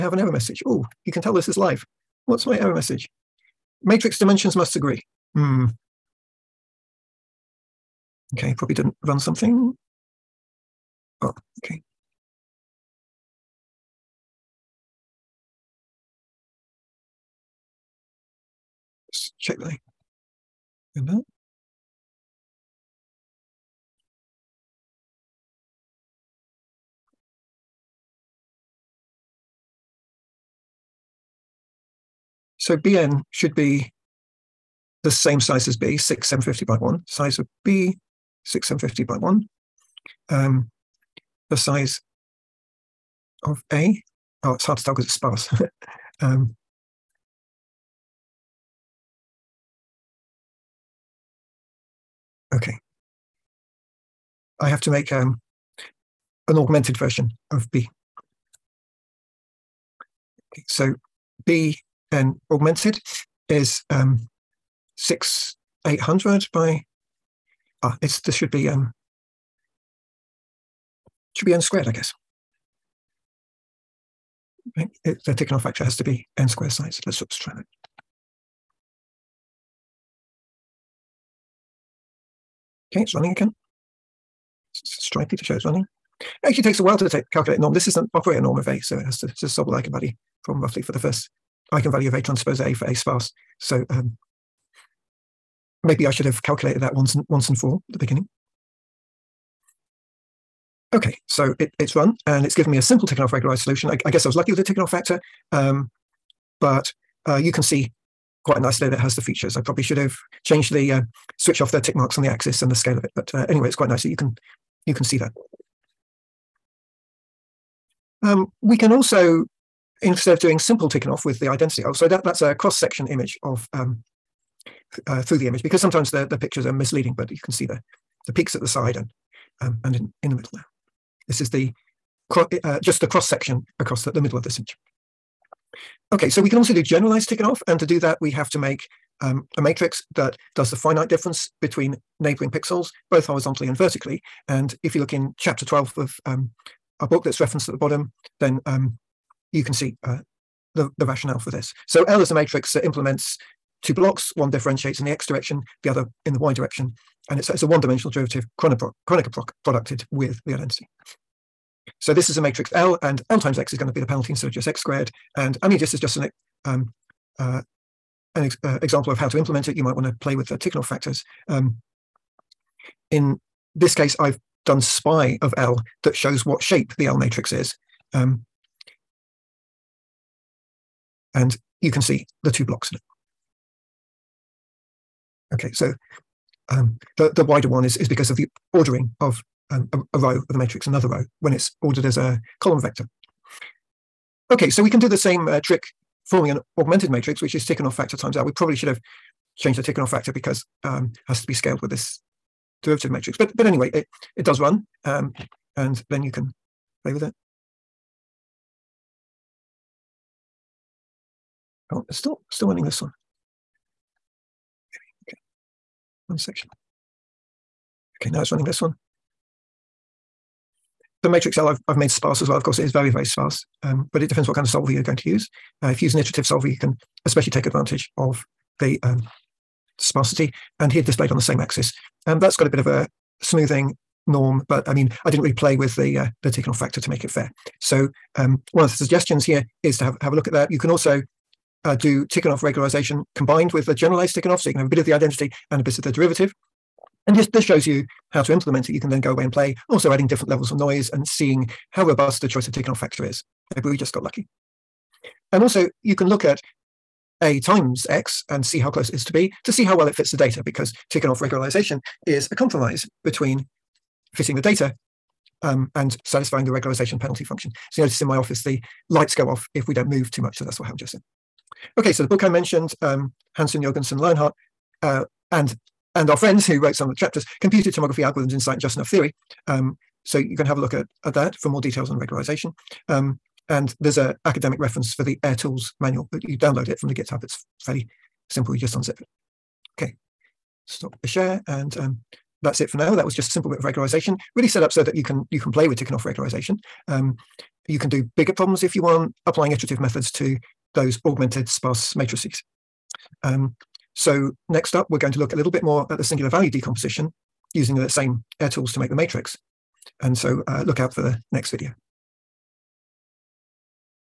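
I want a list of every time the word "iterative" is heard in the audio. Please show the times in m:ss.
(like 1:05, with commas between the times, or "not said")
3:46, 4:59.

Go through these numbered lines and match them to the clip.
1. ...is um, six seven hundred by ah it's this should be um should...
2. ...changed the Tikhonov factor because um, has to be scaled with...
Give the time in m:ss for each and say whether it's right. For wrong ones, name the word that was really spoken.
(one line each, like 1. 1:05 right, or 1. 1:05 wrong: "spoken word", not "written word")
1. 1:03 wrong: "eight", not "seven"
2. 3:19 right.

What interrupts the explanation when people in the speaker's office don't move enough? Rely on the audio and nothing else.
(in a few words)
The lights go off.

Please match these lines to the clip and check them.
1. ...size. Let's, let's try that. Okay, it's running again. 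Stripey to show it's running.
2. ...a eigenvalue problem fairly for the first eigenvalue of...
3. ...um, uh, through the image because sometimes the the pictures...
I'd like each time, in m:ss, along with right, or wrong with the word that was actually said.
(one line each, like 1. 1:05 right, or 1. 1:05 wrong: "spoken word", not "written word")
1. 1:16 right
2. 1:29 wrong: "roughly", not "fairly"
3. 2:03 right.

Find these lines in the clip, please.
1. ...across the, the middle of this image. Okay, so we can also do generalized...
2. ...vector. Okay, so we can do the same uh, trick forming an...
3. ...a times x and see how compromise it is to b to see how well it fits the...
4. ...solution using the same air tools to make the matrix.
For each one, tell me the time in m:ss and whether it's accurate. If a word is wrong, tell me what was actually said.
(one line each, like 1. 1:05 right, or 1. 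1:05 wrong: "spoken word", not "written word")
1. 2:13 right
2. 3:12 right
3. 4:17 wrong: "close", not "compromise"
4. 5:06 wrong: "decomposition", not "solution".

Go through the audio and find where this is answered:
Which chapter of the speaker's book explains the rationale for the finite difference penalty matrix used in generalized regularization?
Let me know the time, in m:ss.
2:25.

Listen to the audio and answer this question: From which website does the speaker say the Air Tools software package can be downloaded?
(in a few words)
GitHub.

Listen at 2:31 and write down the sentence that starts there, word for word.
So L is a matrix that implements two blocks, one differentiates in the x direction, the other in the y direction.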